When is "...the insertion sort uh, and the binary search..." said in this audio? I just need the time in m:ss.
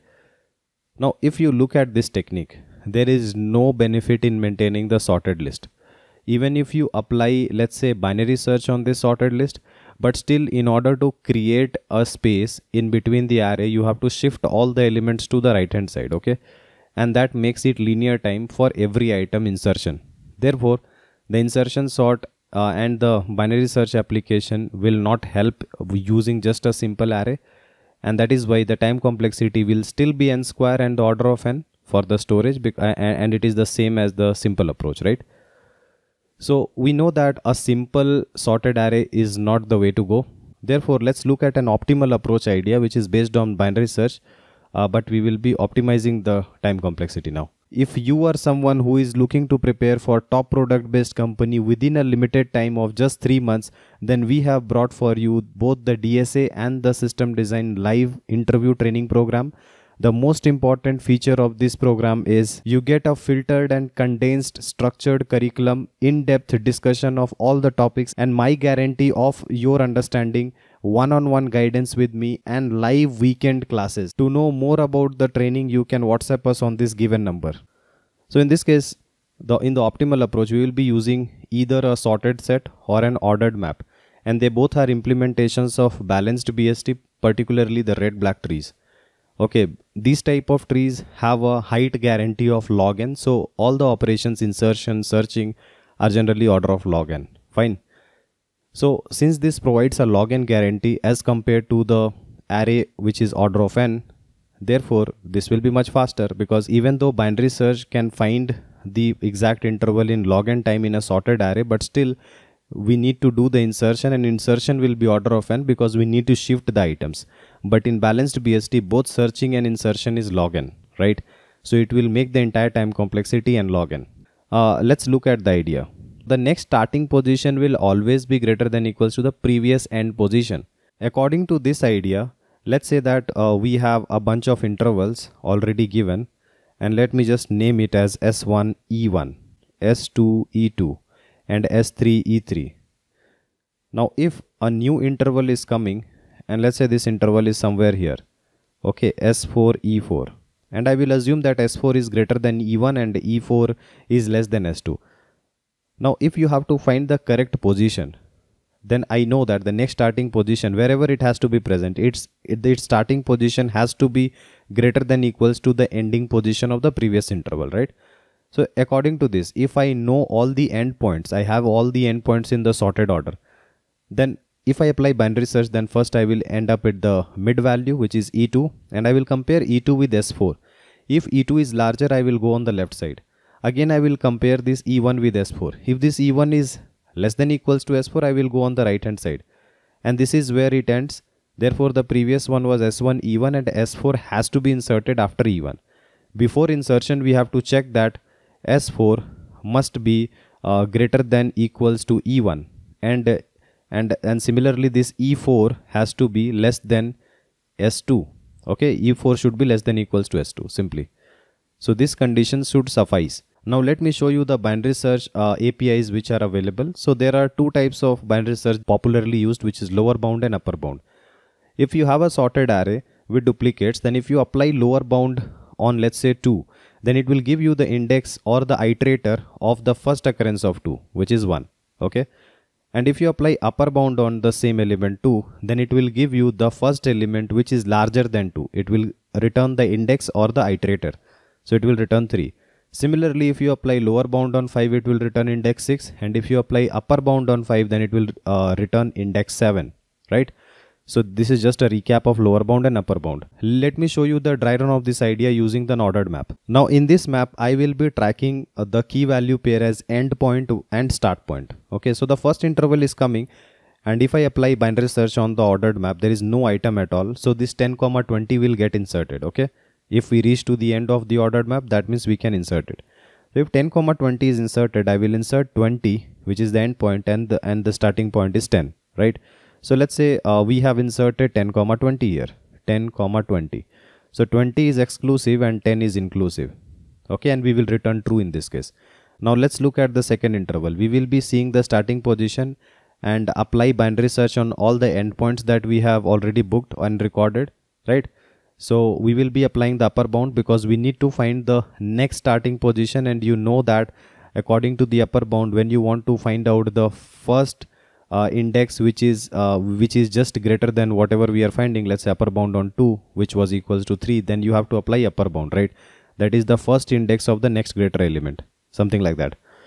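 0:21.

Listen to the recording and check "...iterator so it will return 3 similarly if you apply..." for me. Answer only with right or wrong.
right.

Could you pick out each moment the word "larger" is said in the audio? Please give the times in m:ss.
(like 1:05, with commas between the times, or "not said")
3:01, 3:57.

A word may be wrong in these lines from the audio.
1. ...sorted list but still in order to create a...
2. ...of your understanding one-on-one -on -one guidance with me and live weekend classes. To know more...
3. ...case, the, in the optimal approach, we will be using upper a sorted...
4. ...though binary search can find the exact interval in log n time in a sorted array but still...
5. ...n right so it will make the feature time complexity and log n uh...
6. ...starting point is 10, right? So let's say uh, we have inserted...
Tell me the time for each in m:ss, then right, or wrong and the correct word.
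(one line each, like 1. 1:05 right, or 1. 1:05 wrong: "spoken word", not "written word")
1. 0:09 right
2. 1:09 right
3. 1:18 wrong: "either", not "upper"
4. 1:46 right
5. 2:00 wrong: "entire", not "feature"
6. 4:37 right.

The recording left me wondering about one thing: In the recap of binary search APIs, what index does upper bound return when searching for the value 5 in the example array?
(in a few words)
7.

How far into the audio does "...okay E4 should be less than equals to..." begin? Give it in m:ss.
3:28.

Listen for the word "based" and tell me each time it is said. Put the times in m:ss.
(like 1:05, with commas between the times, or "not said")
0:43, 0:50.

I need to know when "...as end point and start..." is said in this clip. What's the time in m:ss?
4:19.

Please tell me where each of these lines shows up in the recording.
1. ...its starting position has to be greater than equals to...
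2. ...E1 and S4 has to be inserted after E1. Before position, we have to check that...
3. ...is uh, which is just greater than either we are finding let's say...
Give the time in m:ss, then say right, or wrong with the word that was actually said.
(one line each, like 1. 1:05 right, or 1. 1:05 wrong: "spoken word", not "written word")
1. 2:42 right
2. 3:13 wrong: "insertion", not "position"
3. 5:09 wrong: "whatever", not "either".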